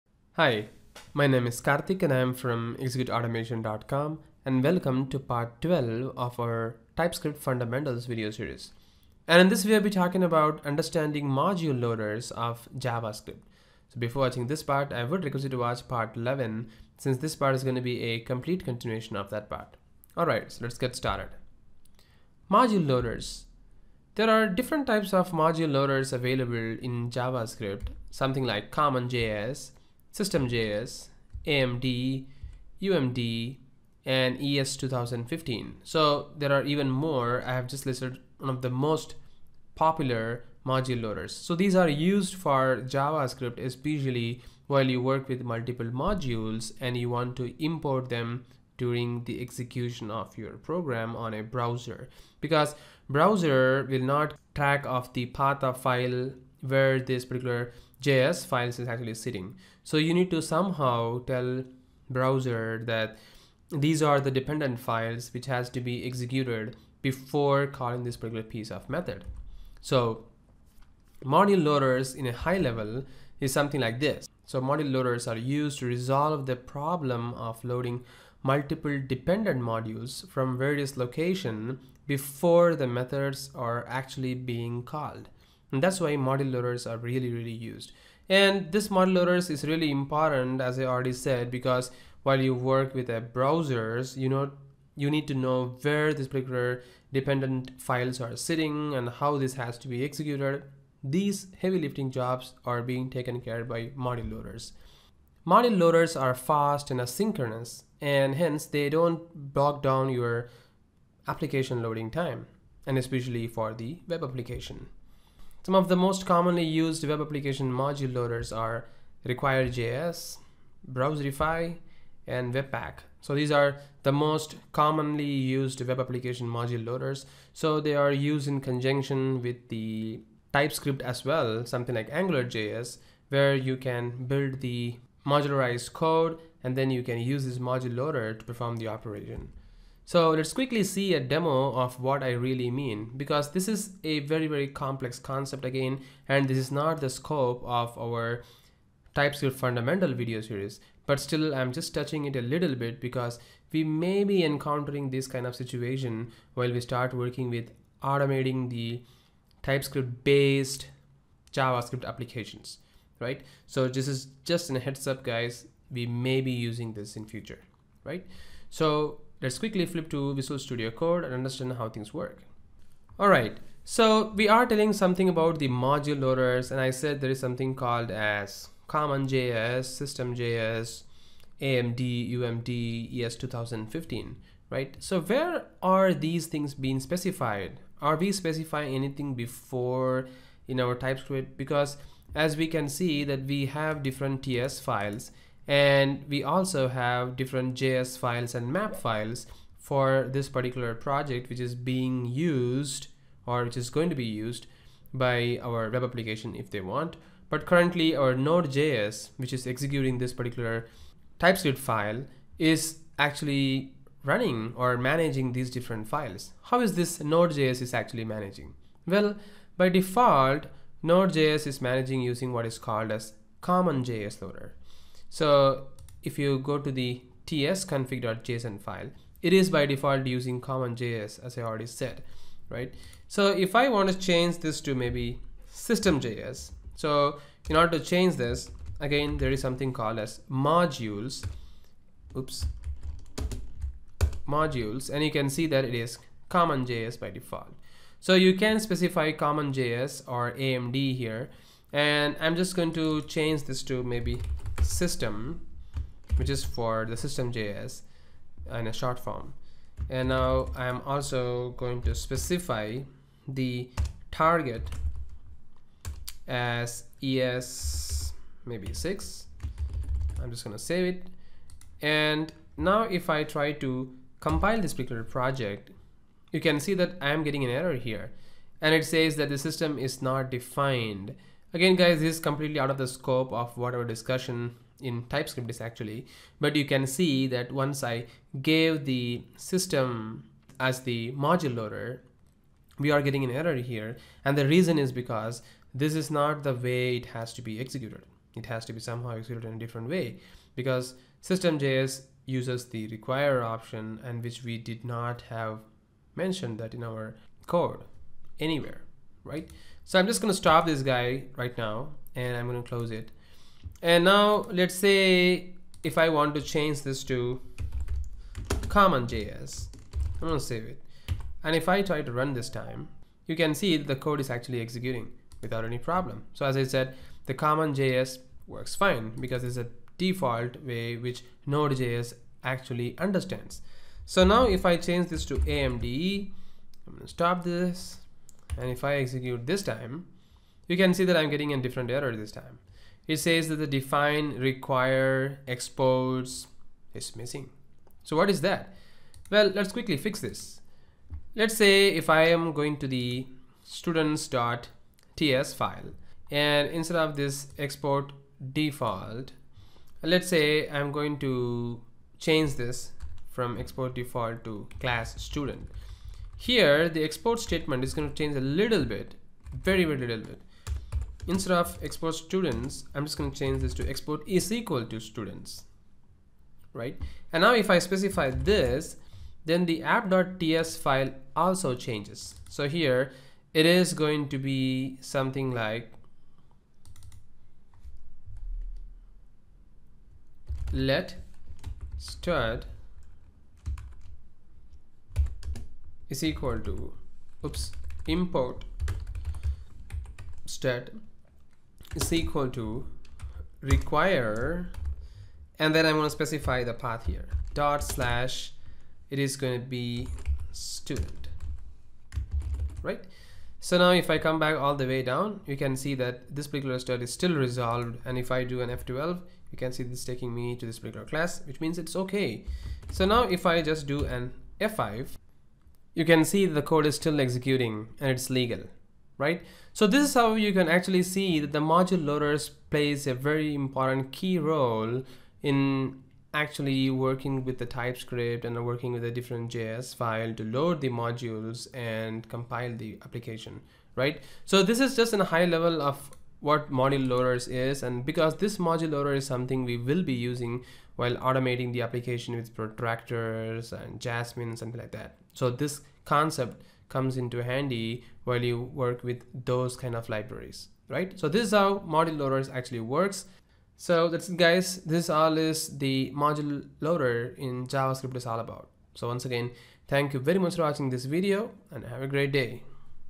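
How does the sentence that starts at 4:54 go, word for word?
And the reason is because this is not the way it has to be executed.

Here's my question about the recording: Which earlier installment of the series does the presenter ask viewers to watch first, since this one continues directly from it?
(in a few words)
Part 11.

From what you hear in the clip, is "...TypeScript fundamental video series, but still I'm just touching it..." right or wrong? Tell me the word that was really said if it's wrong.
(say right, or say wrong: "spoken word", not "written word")
right.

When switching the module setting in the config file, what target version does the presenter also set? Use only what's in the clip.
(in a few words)
ES6.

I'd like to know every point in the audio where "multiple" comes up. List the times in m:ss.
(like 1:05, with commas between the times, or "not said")
0:45, 1:18.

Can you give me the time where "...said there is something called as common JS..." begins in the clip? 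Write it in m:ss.
2:56.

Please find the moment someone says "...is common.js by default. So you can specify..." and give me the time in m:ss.
4:05.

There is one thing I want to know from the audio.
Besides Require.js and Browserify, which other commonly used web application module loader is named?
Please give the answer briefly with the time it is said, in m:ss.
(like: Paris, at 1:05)
Webpack, at 2:02.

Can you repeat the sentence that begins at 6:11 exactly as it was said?
Instead of export students, I'm just going to change this to export is equal to students, right?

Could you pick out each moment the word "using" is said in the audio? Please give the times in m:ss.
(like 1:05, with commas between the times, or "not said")
2:46, 3:42, 3:50, 7:30.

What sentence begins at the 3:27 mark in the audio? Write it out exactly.
But currently our Node.js, which is executing this particular TypeScript file is actually running or managing these different files.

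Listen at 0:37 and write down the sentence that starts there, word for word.
I have just listed one of the most popular module loaders.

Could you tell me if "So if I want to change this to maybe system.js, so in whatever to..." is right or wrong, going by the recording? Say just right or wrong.
wrong.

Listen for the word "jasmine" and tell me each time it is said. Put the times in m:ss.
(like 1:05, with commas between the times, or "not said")
7:34.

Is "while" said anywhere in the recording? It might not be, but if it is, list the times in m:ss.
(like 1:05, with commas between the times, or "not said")
0:44, 1:32, 2:36, 7:31, 7:38.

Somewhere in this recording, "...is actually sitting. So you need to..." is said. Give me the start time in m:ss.
0:58.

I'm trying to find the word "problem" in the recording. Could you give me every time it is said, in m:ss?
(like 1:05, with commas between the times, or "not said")
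1:16, 5:25.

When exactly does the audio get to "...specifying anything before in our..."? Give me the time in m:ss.
3:08.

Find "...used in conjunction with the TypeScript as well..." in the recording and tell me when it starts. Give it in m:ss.
2:08.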